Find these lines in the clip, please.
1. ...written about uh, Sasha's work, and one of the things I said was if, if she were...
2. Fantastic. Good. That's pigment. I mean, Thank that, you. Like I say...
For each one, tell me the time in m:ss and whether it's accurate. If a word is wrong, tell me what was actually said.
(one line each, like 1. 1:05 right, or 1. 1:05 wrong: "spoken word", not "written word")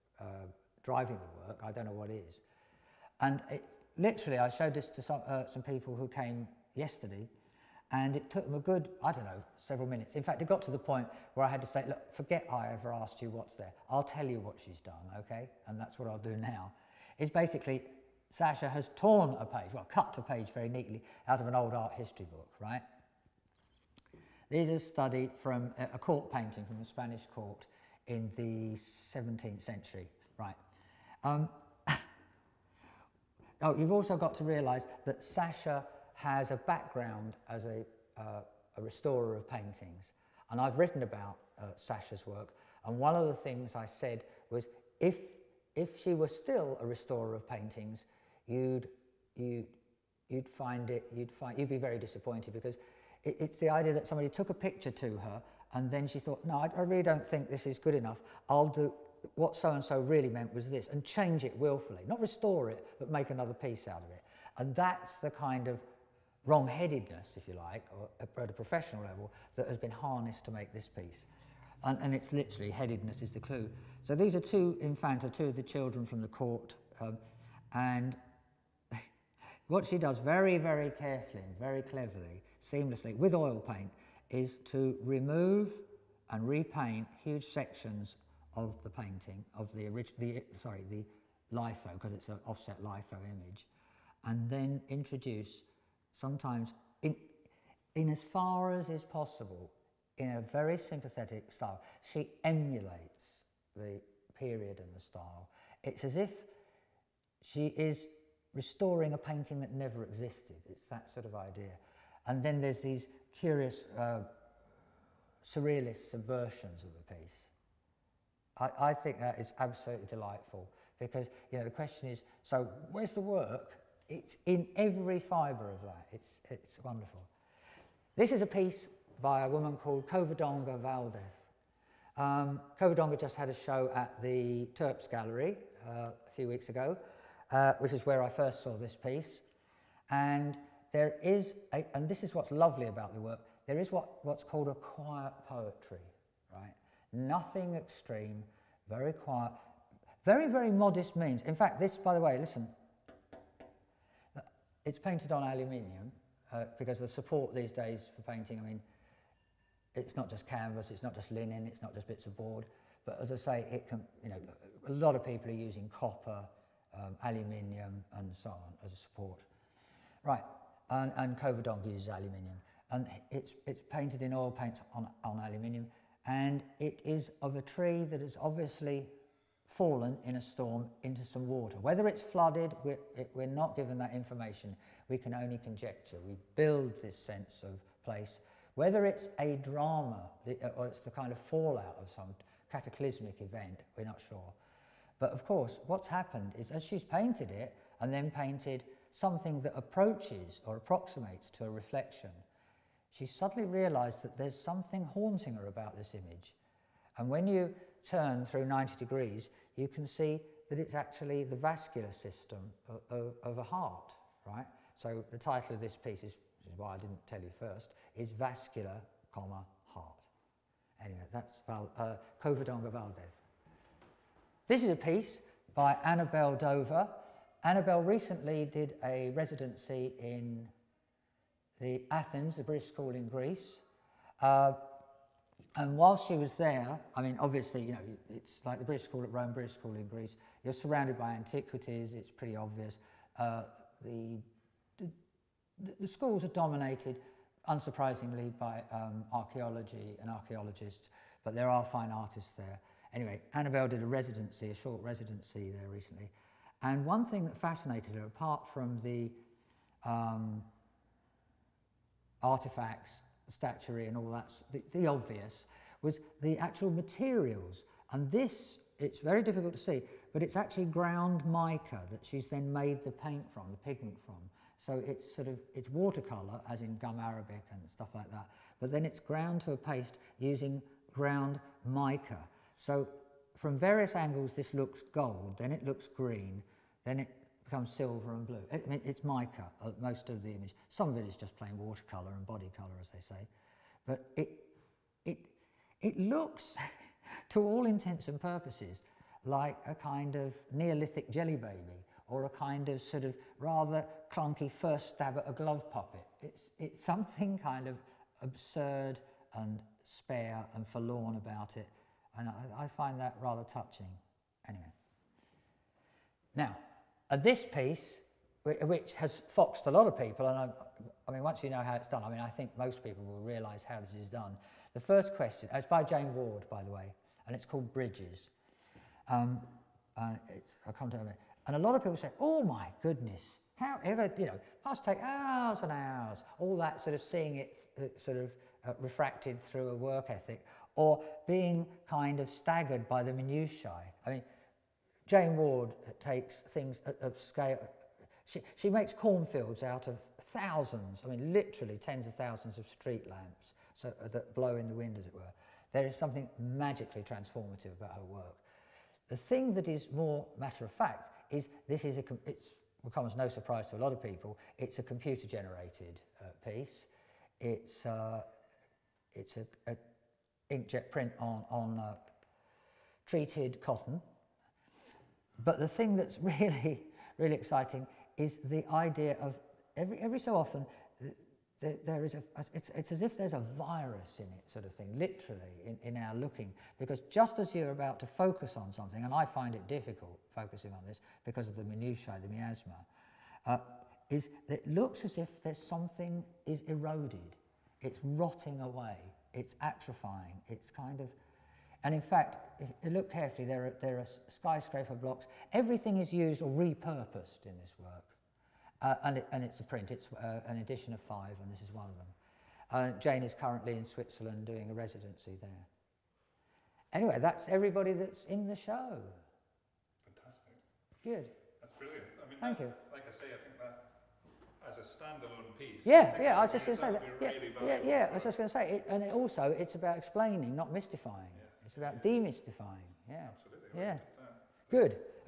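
1. 0:40 right
2. 7:00 wrong: "brilliant", not "pigment".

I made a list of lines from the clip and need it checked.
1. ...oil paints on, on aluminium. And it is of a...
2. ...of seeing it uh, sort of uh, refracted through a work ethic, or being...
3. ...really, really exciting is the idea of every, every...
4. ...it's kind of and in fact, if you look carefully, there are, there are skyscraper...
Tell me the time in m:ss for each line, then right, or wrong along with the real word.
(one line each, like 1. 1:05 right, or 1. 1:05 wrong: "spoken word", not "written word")
1. 2:54 right
2. 5:37 right
3. 6:16 right
4. 6:40 right.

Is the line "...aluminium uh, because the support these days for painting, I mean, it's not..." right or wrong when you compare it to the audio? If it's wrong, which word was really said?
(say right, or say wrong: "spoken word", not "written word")
right.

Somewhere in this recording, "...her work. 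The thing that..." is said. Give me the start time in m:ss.
5:58.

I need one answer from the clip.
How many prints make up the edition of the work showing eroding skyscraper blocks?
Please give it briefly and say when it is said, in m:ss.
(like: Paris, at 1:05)
5, at 6:51.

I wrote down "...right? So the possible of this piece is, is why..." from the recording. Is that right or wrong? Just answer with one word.
wrong.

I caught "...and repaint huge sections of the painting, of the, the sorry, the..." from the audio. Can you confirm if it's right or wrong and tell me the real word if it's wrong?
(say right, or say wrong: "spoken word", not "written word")
right.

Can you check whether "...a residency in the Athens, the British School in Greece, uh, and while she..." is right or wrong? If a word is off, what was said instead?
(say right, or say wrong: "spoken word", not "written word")
right.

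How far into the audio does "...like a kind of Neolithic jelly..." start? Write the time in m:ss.
4:59.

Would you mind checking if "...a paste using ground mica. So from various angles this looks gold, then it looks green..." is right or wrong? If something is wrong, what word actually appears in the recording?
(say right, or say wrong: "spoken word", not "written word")
right.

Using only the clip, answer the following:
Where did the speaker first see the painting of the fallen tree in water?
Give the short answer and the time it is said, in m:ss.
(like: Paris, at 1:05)
Turps Gallery, at 2:14.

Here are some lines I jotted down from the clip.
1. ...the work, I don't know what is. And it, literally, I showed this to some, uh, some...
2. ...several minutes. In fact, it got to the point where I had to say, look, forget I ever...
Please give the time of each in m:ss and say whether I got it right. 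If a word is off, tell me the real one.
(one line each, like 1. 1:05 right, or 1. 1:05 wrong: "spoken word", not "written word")
1. 0:01 right
2. 0:09 right.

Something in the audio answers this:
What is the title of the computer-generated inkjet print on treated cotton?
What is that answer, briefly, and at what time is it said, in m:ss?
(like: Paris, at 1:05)
Bridges, at 5:27.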